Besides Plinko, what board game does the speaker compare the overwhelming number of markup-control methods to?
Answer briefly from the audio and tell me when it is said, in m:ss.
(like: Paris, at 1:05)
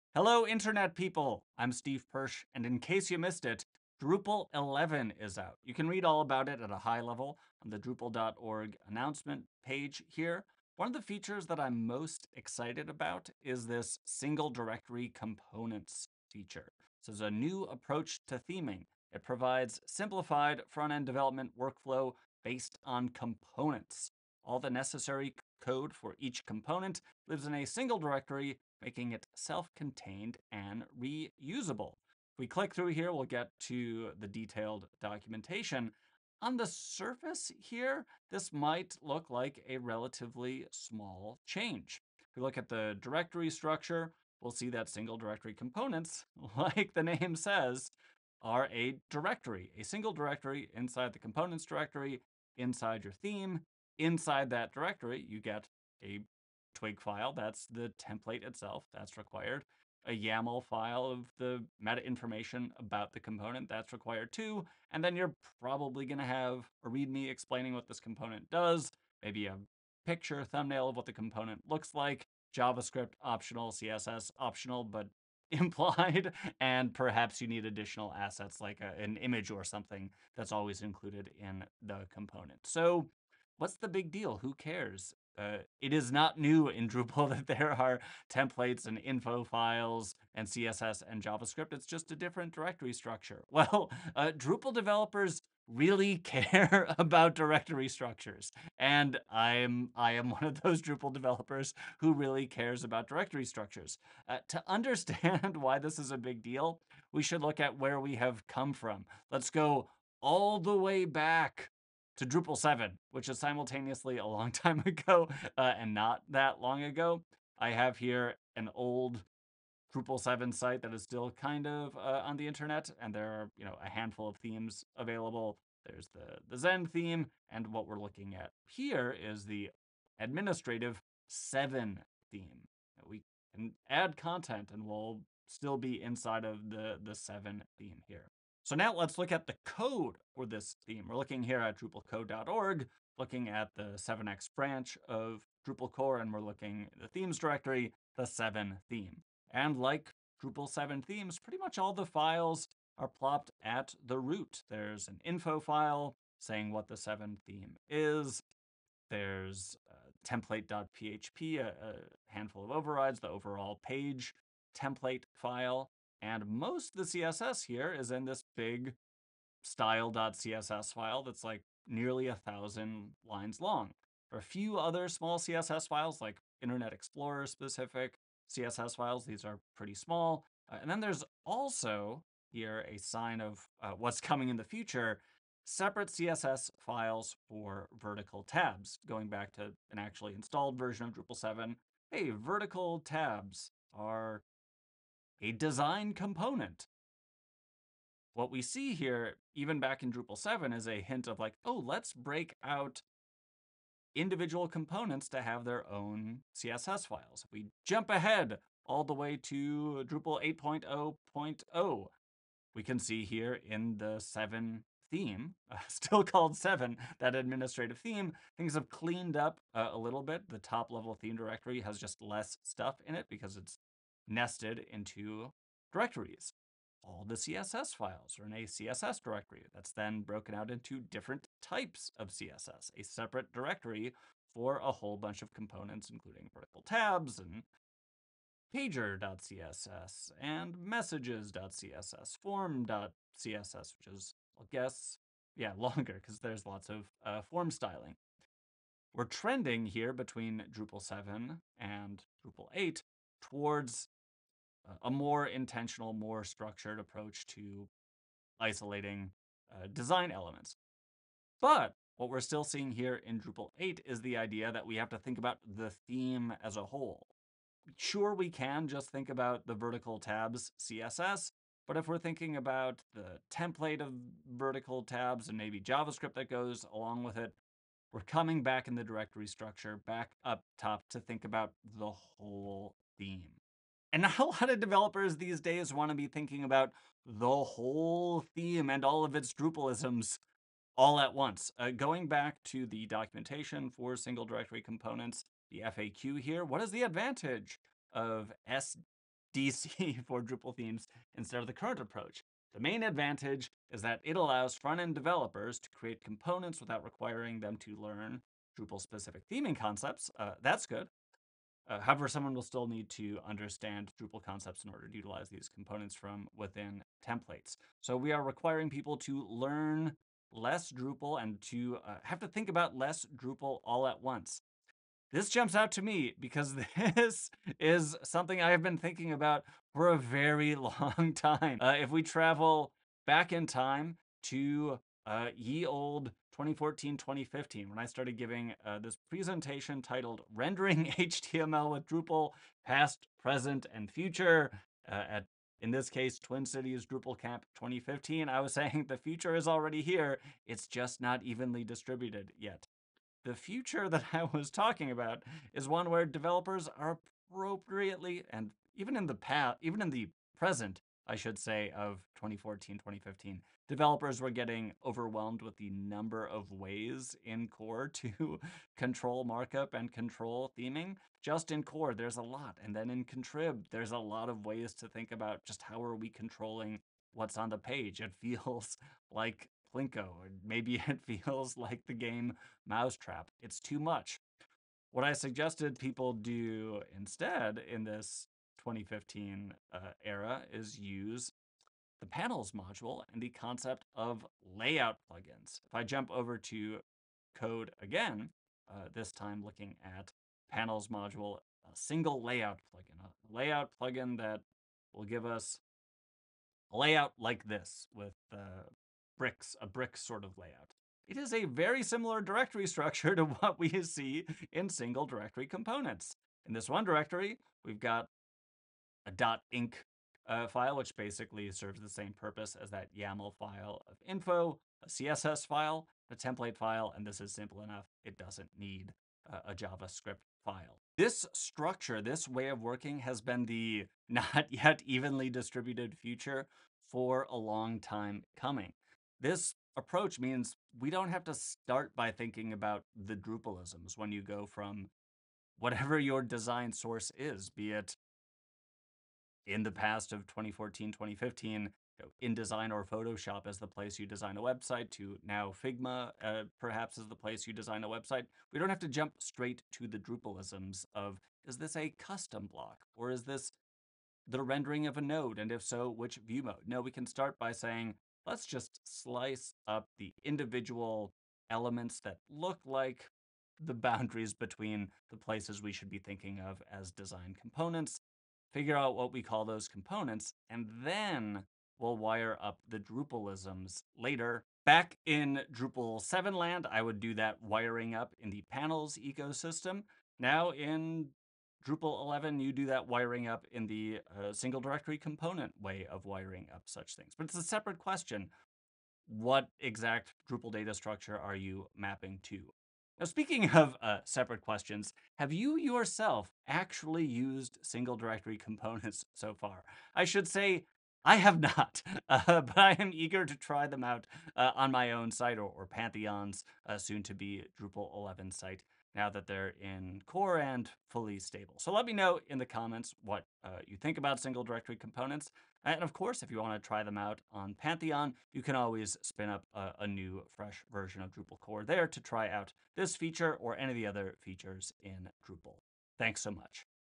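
Mousetrap, at 6:22.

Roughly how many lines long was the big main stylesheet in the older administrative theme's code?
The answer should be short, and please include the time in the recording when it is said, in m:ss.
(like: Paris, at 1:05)
nearly a thousand, at 2:51.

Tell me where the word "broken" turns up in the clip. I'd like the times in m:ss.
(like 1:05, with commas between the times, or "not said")
3:50.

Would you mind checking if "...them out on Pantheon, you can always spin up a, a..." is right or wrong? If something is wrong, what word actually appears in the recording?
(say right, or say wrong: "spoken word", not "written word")
right.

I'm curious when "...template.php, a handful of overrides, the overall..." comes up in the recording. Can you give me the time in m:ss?
2:40.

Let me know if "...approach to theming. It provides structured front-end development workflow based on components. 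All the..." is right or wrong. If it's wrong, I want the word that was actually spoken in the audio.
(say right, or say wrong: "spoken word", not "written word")
wrong: "simplified", not "structured".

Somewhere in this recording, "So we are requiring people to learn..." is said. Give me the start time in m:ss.
5:18.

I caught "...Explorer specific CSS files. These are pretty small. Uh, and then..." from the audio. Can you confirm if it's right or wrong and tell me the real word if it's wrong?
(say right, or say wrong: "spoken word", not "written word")
right.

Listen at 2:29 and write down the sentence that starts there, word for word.
And like Drupal 7 themes, pretty much all the files are plopped at the root.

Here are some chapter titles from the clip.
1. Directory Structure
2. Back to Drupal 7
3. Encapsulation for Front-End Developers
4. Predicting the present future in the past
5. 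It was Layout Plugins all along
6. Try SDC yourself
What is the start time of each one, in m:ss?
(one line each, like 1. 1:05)
1. 0:43
2. 1:43
3. 4:40
4. 5:28
5. 6:36
6. 8:15.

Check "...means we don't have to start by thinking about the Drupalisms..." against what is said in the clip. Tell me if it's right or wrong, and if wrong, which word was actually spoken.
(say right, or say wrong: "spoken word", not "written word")
right.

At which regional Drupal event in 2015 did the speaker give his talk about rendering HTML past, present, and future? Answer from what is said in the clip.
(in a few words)
Twin Cities Drupal Camp.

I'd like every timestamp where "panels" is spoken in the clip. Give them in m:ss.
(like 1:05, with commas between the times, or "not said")
6:32, 6:40, 8:08.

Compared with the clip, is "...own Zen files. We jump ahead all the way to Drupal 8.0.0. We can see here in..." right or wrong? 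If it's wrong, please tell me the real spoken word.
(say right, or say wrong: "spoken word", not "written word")
wrong: "CSS", not "Zen".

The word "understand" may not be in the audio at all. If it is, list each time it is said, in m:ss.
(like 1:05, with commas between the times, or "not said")
1:44, 5:13.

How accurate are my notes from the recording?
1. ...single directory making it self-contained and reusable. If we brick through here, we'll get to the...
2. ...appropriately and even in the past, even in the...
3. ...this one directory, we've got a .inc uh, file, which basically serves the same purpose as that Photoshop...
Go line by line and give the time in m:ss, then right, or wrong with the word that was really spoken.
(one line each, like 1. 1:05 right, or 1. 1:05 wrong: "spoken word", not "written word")
1. 0:27 wrong: "click", not "brick"
2. 5:57 right
3. 6:56 wrong: "YAML", not "Photoshop".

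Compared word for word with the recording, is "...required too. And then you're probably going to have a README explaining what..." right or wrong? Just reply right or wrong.
right.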